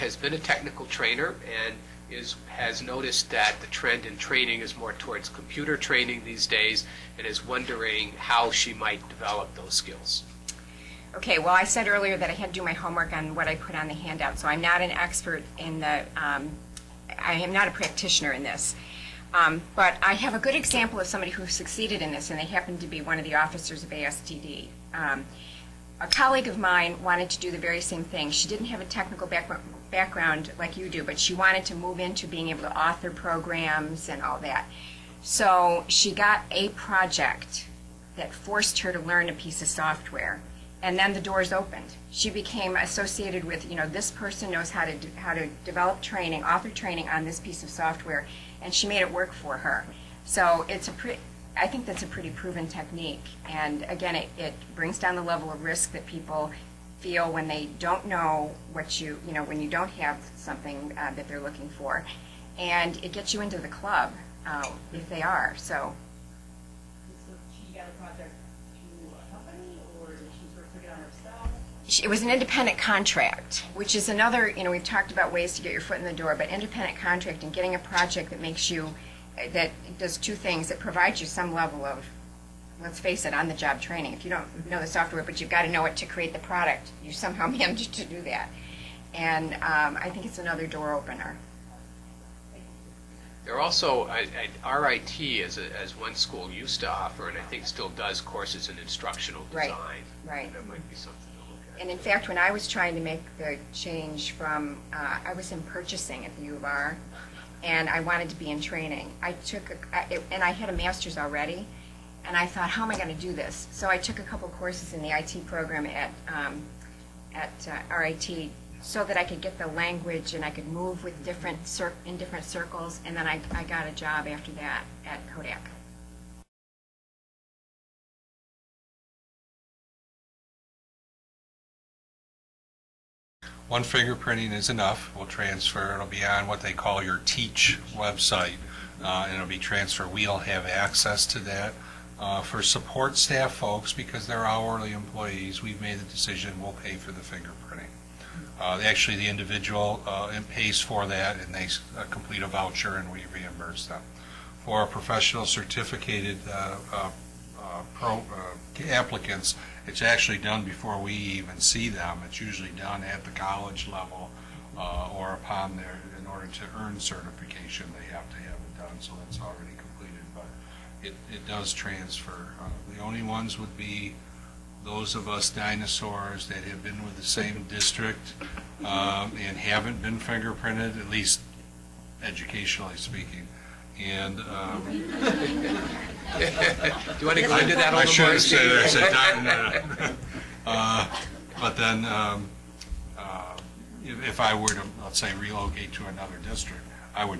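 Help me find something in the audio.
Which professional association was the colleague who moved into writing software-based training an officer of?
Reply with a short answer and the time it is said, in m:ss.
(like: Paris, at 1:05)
ASTD, at 0:23.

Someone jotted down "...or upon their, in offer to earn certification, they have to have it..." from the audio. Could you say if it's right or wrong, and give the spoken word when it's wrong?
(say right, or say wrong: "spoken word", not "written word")
wrong: "order", not "offer".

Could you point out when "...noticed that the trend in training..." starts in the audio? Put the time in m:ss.
0:02.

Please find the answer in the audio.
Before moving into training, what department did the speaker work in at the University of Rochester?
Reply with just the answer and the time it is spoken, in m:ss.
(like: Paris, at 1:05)
purchasing, at 1:45.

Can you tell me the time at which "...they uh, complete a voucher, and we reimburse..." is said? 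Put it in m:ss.
2:31.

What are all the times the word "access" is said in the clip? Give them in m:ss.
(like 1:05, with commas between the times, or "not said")
2:20.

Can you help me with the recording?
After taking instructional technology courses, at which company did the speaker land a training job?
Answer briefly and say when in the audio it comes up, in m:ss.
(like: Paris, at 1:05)
Kodak, at 2:05.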